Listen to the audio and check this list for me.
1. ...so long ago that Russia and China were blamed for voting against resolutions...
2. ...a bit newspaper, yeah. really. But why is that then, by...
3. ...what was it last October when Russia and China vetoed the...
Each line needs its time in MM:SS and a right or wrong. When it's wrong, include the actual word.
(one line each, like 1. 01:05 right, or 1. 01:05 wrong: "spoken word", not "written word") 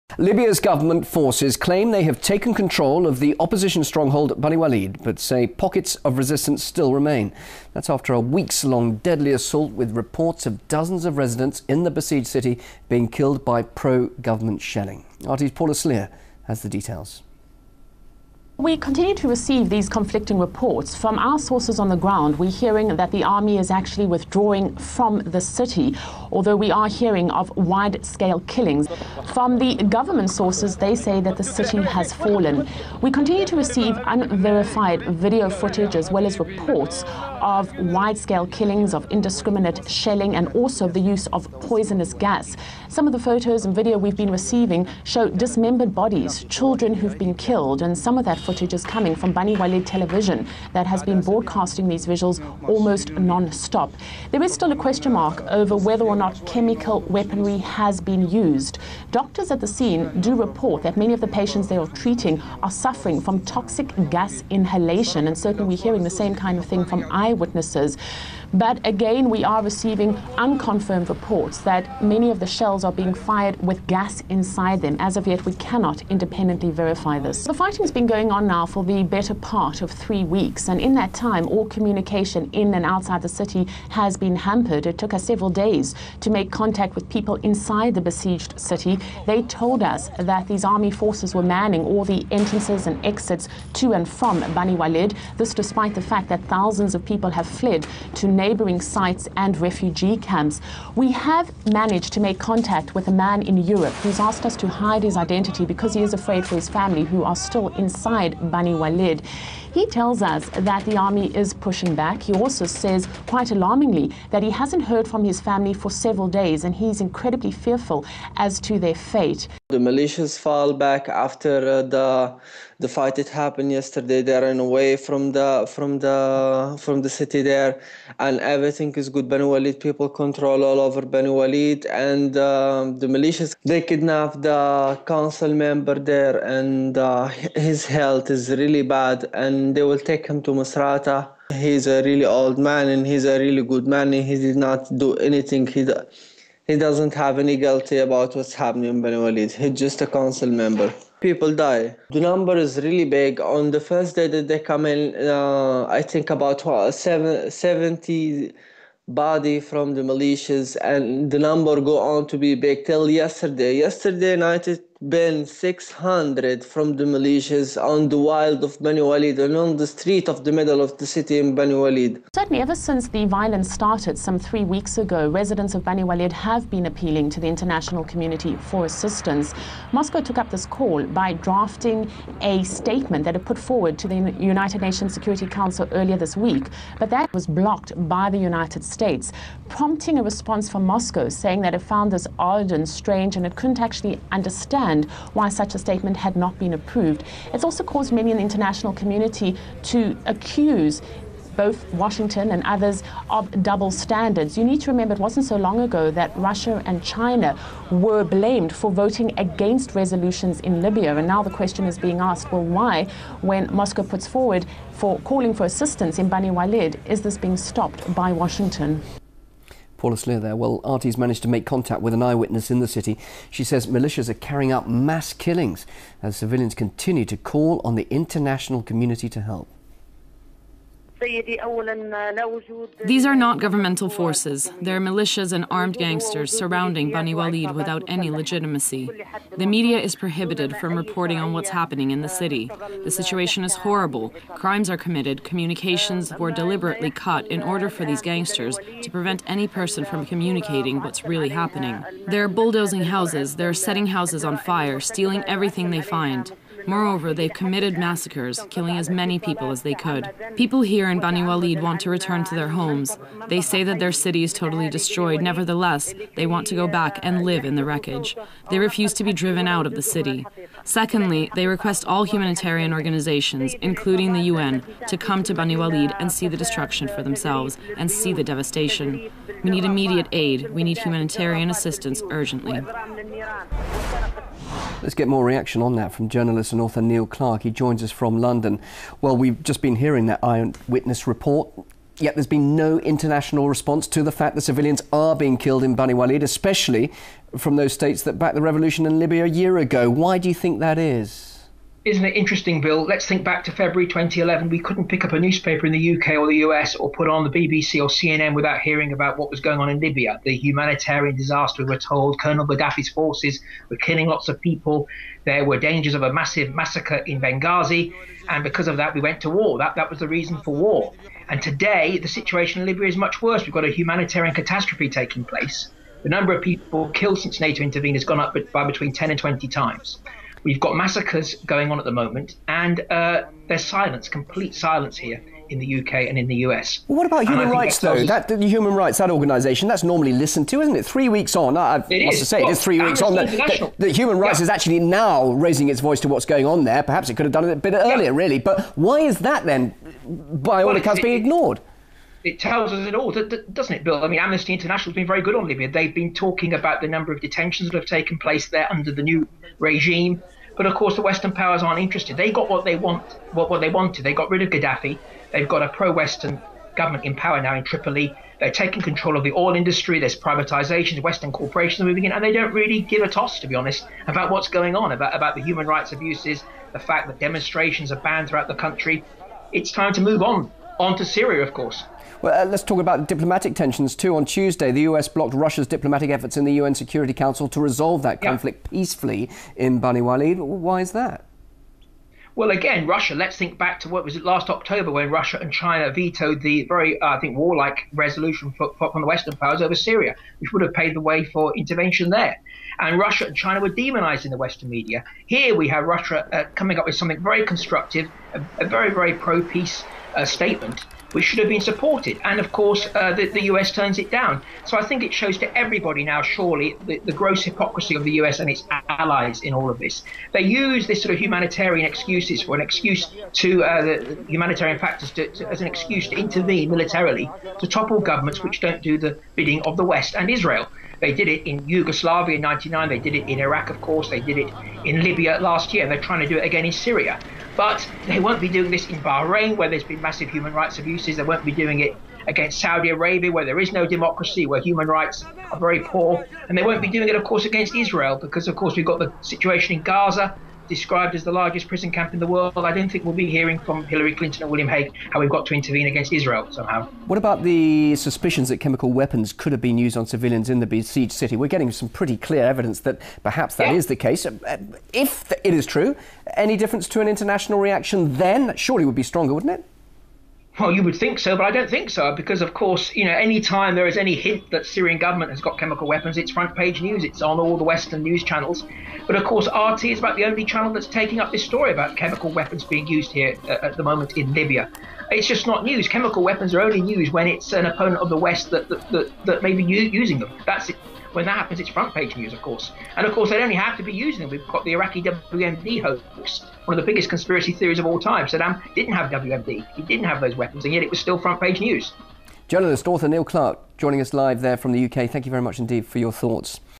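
1. 03:25 right
2. 05:47 wrong: "earlier", not "newspaper"
3. 06:34 right.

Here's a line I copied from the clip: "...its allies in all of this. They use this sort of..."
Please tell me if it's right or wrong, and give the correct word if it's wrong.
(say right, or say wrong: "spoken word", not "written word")
right.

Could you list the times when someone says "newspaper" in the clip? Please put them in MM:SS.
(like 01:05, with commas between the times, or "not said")
05:05.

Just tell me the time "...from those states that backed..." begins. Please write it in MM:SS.
04:57.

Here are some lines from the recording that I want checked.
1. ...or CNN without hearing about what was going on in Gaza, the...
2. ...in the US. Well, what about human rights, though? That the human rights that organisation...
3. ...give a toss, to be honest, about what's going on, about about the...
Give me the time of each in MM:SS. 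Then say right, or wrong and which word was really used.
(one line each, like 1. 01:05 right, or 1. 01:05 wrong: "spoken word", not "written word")
1. 05:08 wrong: "Libya", not "Gaza"
2. 05:36 right
3. 06:13 right.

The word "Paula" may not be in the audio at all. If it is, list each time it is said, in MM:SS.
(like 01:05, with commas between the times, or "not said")
00:15, 03:40.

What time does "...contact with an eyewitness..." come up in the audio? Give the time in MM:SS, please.
03:41.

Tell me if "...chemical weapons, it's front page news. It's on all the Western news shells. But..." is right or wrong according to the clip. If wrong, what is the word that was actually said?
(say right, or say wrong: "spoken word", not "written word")
wrong: "channels", not "shells".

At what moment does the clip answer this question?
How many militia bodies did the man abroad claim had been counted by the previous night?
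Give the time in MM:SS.
02:45.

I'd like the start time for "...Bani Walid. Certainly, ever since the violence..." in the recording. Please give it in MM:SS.
02:51.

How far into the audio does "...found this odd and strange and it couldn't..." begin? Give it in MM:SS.
03:11.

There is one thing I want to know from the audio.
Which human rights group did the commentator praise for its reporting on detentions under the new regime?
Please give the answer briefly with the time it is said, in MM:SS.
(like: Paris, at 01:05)
Amnesty International, at 05:54.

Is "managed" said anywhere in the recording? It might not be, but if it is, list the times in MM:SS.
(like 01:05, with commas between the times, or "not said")
01:41, 03:41.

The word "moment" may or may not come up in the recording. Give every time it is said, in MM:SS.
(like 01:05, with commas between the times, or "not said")
05:32, 08:04.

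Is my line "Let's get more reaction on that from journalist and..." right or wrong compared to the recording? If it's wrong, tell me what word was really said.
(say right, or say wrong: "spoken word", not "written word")
right.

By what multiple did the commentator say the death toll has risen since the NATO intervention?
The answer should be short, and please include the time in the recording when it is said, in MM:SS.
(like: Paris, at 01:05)
10 and 20 times, at 05:29.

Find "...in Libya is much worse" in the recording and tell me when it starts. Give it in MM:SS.
05:22.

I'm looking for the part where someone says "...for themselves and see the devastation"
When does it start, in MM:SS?
04:37.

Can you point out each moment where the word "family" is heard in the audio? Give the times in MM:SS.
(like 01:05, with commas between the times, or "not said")
01:46, 01:55.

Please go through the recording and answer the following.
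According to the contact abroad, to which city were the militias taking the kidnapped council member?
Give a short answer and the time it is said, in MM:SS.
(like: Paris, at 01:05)
Masrata, at 02:20.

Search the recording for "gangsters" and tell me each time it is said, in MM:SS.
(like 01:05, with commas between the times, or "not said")
03:55, 04:08.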